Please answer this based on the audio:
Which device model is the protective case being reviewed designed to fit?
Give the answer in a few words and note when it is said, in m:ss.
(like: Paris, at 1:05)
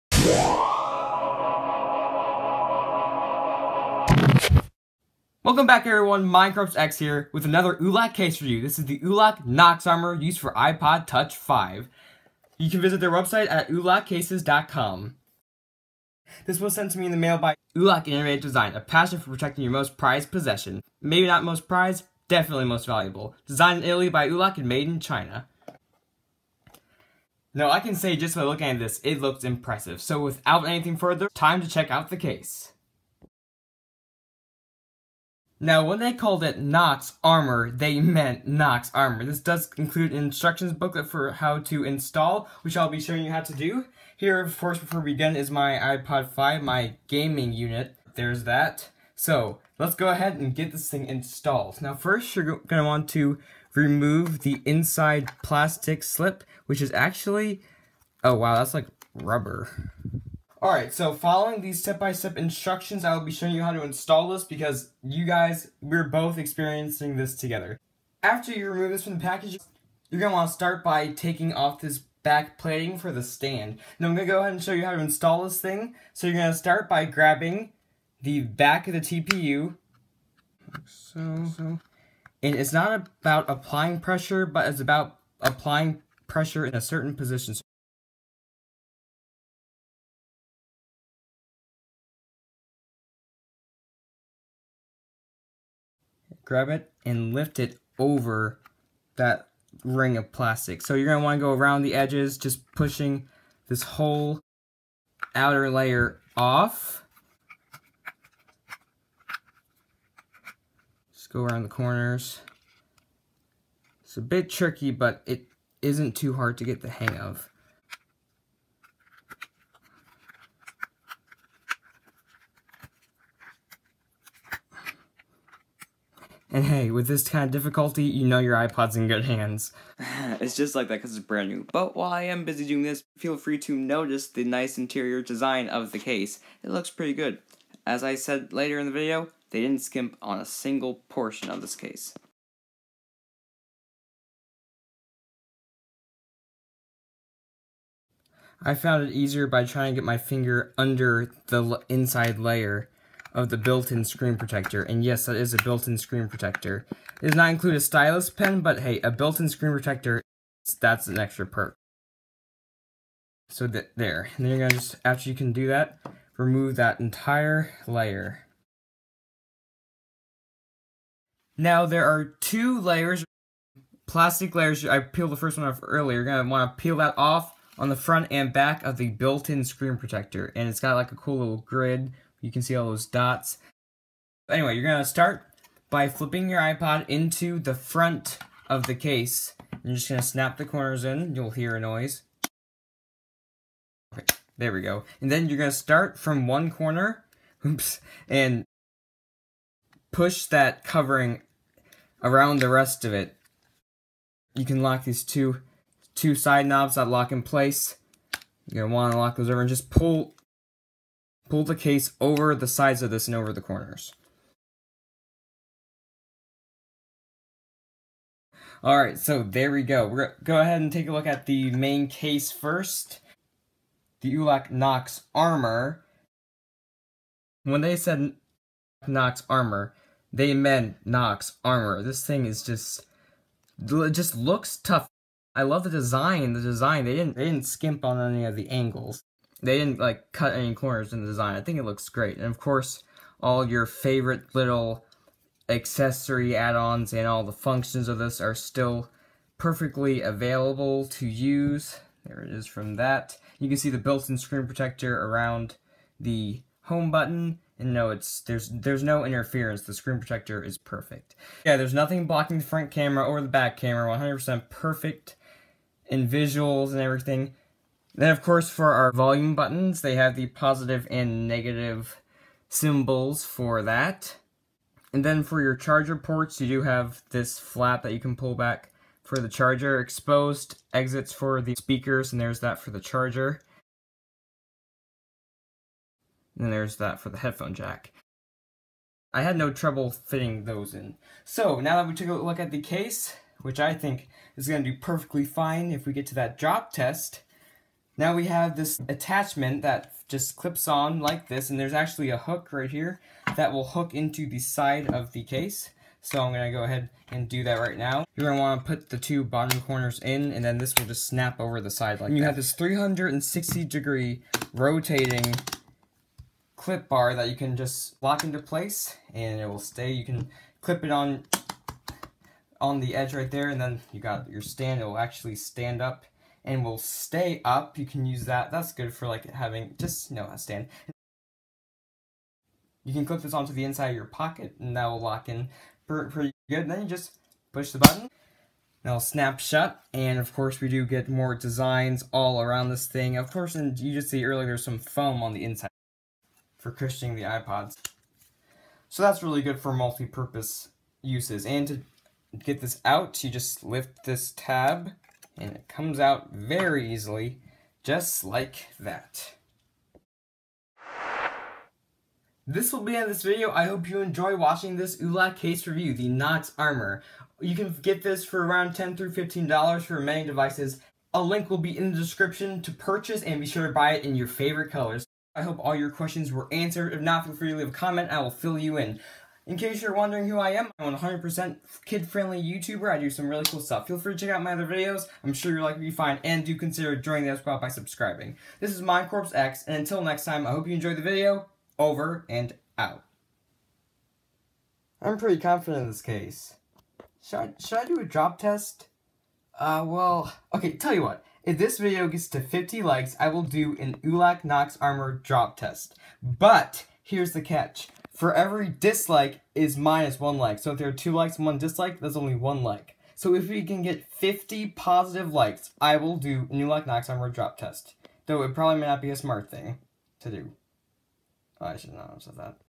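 iPod Touch 5, at 0:10.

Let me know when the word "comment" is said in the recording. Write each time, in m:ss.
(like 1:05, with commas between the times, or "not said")
6:17.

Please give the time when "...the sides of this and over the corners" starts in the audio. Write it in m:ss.
3:32.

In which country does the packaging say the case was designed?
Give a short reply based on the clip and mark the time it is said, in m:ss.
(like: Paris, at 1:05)
Italy, at 0:23.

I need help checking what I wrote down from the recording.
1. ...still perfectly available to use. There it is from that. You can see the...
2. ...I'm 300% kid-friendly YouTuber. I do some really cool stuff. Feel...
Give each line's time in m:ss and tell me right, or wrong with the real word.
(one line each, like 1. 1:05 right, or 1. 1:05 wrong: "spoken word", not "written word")
1. 4:08 right
2. 6:20 wrong: "100", not "300".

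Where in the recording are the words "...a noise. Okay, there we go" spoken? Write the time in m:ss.
3:11.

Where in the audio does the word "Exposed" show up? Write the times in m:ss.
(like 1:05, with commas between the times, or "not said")
4:39.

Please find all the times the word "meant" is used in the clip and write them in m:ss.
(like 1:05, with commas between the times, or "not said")
0:37, 3:50.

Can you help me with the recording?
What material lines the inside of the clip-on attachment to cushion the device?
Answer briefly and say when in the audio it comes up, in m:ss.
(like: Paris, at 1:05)
foam, at 5:44.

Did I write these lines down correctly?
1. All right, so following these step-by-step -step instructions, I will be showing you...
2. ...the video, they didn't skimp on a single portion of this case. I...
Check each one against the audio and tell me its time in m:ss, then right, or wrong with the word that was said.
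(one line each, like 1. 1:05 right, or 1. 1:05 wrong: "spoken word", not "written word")
1. 1:00 right
2. 2:18 right.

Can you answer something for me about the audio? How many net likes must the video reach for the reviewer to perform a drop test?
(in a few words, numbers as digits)
50.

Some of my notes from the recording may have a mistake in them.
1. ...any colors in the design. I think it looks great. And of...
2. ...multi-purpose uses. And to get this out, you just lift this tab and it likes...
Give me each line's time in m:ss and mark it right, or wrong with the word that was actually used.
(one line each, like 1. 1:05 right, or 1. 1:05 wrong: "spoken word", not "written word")
1. 4:00 wrong: "corners", not "colors"
2. 5:49 wrong: "comes", not "likes".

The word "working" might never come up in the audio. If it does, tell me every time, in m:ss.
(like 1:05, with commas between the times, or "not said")
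not said.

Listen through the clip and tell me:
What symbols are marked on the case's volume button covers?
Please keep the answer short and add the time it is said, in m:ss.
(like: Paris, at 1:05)
positive and negative, at 4:30.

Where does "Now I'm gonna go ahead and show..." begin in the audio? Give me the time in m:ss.
1:13.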